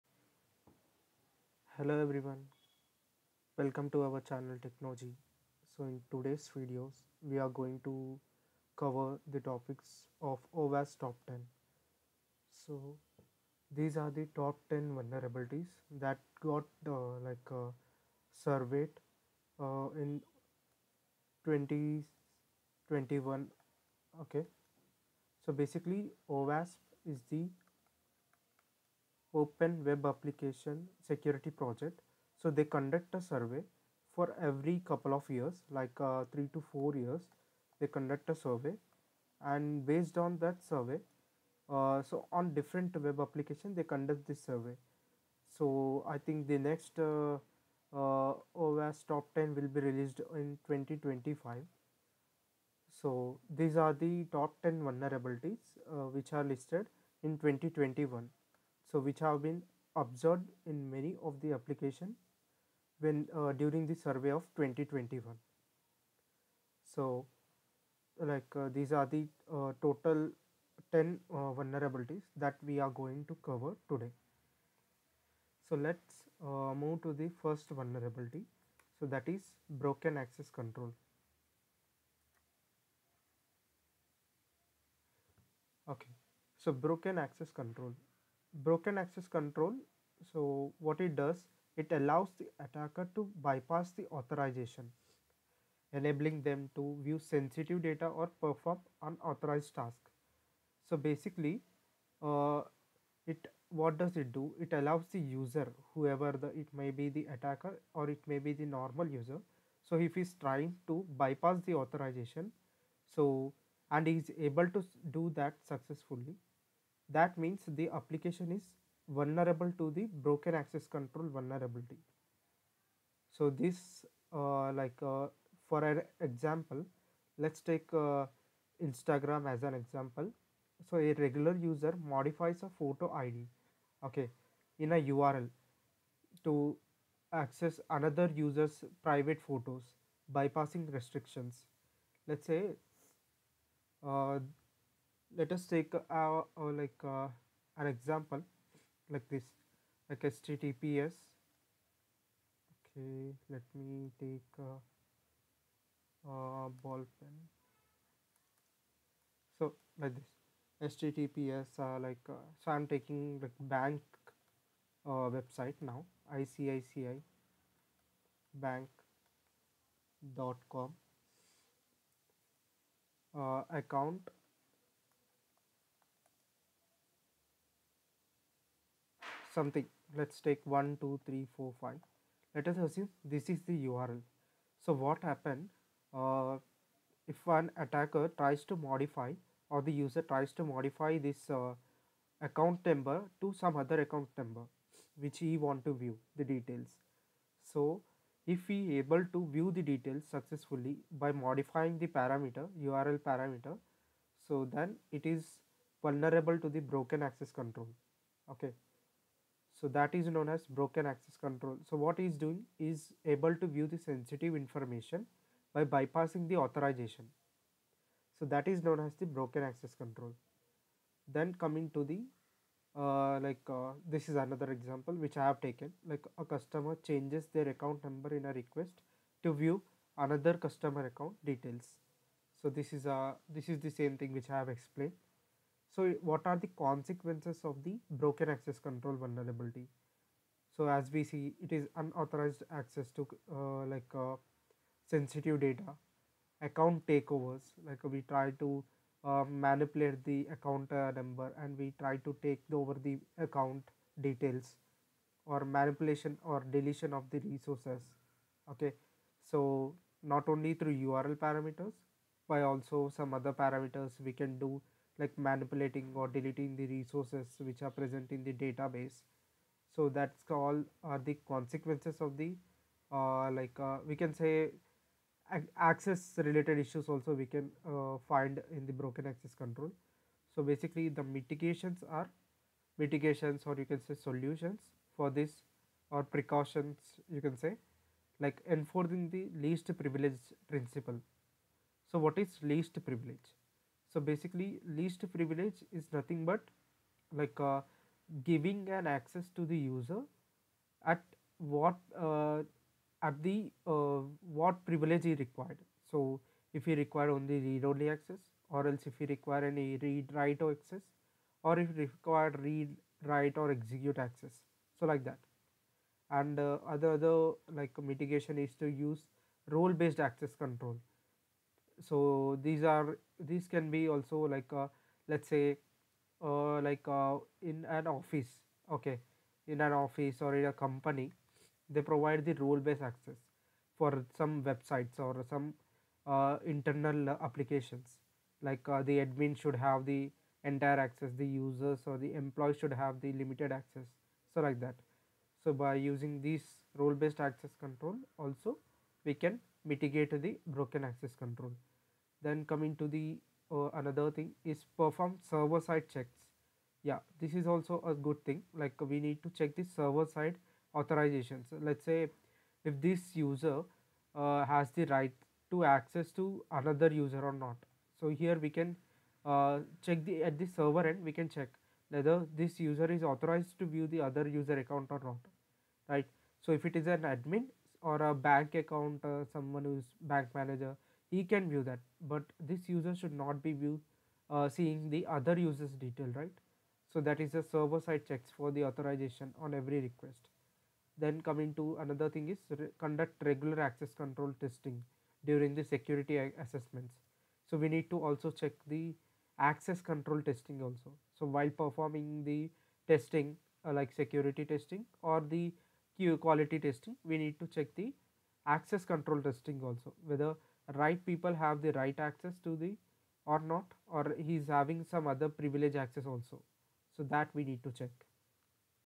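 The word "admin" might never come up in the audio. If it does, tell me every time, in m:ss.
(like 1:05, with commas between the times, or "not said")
5:39, 6:17.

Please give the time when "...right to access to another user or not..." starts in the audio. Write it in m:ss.
6:05.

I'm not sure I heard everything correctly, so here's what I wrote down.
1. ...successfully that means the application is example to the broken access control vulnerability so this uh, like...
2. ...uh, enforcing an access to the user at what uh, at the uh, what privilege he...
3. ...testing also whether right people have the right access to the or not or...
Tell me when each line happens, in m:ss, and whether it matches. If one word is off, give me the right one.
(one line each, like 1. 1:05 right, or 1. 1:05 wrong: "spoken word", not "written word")
1. 1:55 wrong: "vulnerable", not "example"
2. 4:57 wrong: "giving", not "enforcing"
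3. 6:49 right.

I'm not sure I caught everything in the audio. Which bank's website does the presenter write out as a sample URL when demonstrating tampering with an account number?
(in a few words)
ICICI Bank.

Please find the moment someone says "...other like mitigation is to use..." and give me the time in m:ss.
5:17.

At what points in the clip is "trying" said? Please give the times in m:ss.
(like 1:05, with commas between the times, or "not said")
1:50.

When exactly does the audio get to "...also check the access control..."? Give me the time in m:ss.
6:38.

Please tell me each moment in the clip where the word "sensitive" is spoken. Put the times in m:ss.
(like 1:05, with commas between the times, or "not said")
1:37, 3:33, 4:05.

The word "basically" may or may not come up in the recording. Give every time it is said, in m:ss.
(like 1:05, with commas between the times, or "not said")
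0:25, 1:40, 4:40, 4:54.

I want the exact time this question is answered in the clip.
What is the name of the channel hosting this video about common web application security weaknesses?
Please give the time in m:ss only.
0:04.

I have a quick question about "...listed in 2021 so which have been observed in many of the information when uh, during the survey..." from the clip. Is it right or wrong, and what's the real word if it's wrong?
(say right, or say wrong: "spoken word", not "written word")
wrong: "application", not "information".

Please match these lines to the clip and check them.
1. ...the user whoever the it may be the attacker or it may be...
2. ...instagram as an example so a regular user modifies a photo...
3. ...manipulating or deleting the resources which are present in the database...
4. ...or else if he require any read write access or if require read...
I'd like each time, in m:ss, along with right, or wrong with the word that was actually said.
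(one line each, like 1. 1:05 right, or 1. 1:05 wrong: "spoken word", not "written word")
1. 1:45 right
2. 2:08 right
3. 4:25 right
4. 5:08 right.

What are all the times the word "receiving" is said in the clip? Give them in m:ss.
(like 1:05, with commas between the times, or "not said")
not said.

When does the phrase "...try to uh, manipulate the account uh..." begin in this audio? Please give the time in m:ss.
4:08.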